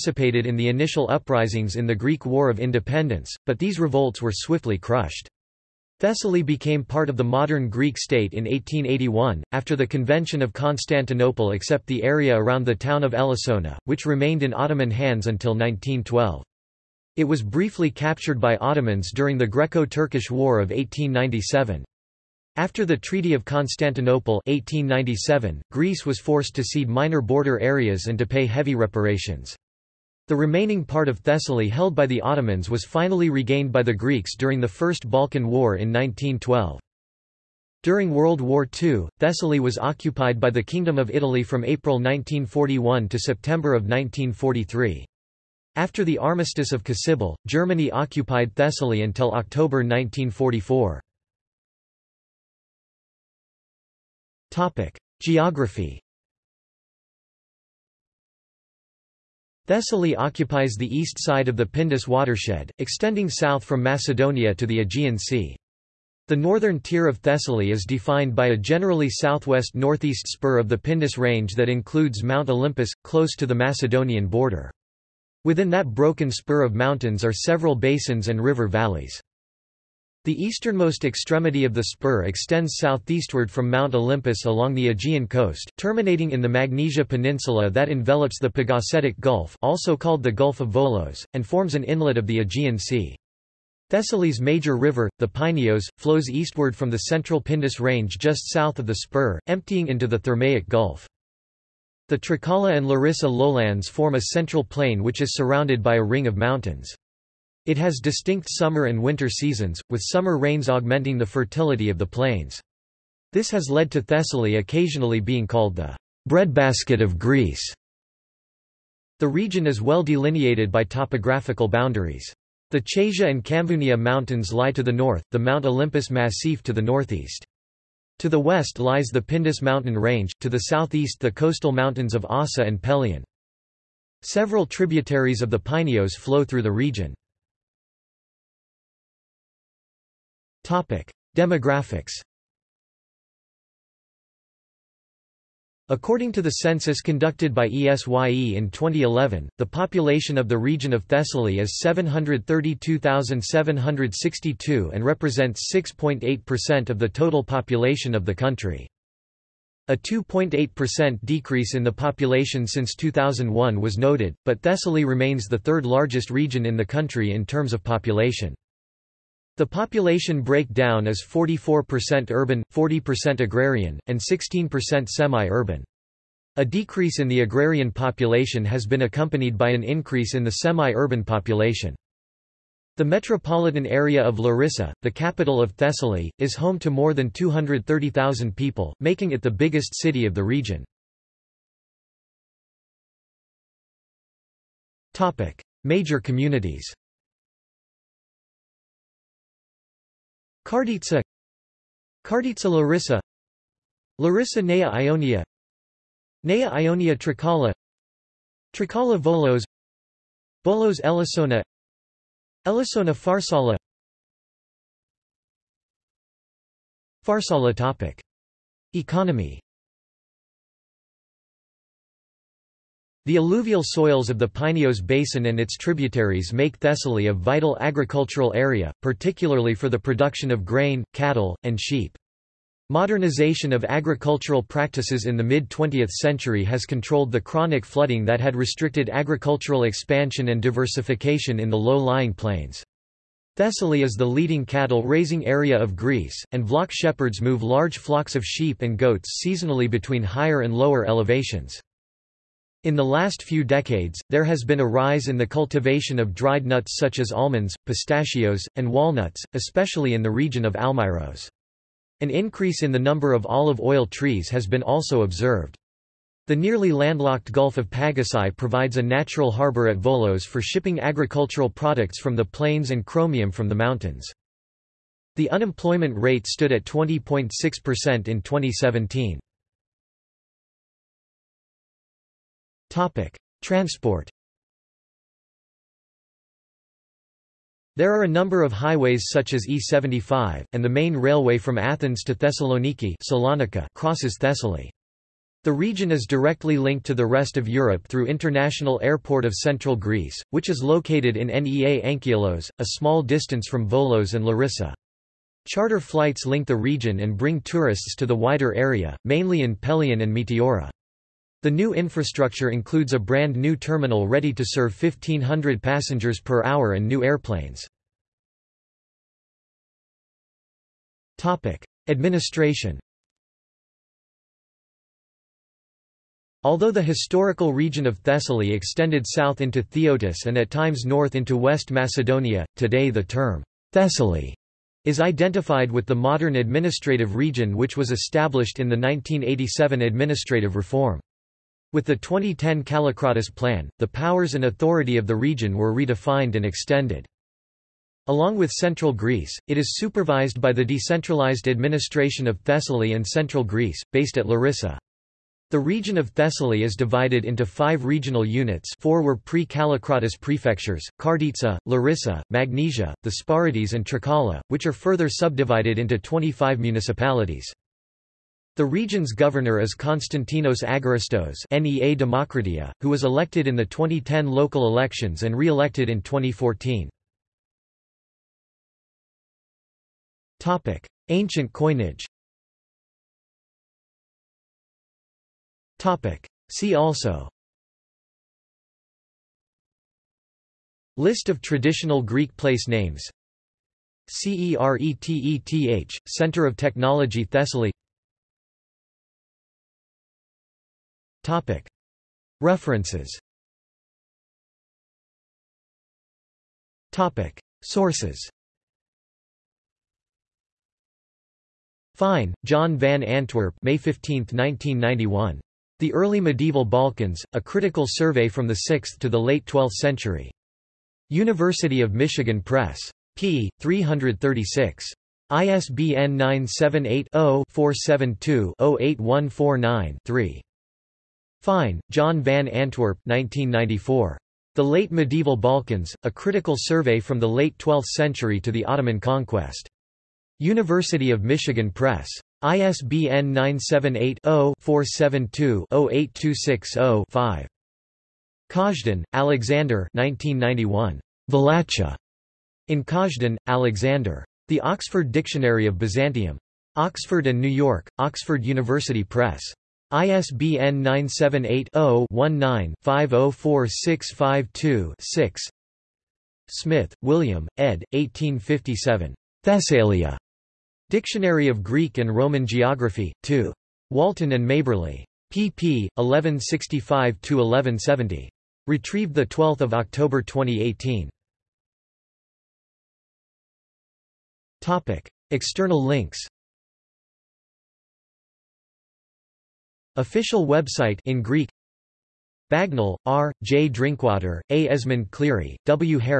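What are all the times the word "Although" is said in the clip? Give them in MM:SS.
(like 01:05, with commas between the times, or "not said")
05:26.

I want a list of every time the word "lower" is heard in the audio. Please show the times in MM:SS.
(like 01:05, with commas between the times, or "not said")
04:10.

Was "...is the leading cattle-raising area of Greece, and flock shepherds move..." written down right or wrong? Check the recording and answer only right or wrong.
right.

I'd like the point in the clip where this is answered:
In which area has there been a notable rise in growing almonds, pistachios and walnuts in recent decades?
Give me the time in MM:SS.
04:20.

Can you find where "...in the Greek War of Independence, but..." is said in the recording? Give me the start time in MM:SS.
00:01.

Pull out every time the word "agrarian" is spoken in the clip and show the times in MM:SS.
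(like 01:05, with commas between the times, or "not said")
02:53, 02:57.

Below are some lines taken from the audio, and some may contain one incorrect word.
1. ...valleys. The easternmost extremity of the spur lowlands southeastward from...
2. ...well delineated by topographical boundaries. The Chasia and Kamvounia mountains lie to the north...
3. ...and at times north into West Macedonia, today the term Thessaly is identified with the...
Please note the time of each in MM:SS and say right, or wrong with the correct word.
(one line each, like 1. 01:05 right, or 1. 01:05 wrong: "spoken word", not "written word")
1. 01:18 wrong: "extends", not "lowlands"
2. 01:59 right
3. 05:30 right.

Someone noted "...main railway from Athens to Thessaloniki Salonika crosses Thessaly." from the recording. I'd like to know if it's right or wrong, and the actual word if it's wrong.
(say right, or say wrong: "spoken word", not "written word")
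right.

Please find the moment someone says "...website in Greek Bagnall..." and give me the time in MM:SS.
08:10.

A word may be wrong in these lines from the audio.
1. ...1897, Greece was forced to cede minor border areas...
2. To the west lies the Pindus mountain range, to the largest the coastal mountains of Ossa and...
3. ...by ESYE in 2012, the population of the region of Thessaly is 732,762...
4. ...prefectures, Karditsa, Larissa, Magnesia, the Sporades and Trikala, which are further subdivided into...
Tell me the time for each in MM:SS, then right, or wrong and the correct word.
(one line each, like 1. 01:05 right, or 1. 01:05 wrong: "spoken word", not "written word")
1. 00:24 right
2. 02:08 wrong: "southeast", not "largest"
3. 02:27 wrong: "2011", not "2012"
4. 06:00 right.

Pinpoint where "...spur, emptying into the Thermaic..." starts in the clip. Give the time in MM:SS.
01:38.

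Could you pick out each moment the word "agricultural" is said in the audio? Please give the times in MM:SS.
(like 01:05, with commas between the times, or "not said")
03:47, 03:53, 03:59, 04:30.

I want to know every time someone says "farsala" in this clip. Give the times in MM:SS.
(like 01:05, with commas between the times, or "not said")
03:33, 03:37.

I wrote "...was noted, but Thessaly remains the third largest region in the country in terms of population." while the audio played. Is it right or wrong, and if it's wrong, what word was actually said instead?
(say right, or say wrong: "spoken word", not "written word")
right.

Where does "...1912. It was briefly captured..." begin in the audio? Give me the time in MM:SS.
00:15.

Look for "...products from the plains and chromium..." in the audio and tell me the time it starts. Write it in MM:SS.
04:31.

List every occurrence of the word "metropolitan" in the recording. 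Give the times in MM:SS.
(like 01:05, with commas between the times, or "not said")
03:03.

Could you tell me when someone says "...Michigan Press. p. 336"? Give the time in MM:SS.
07:02.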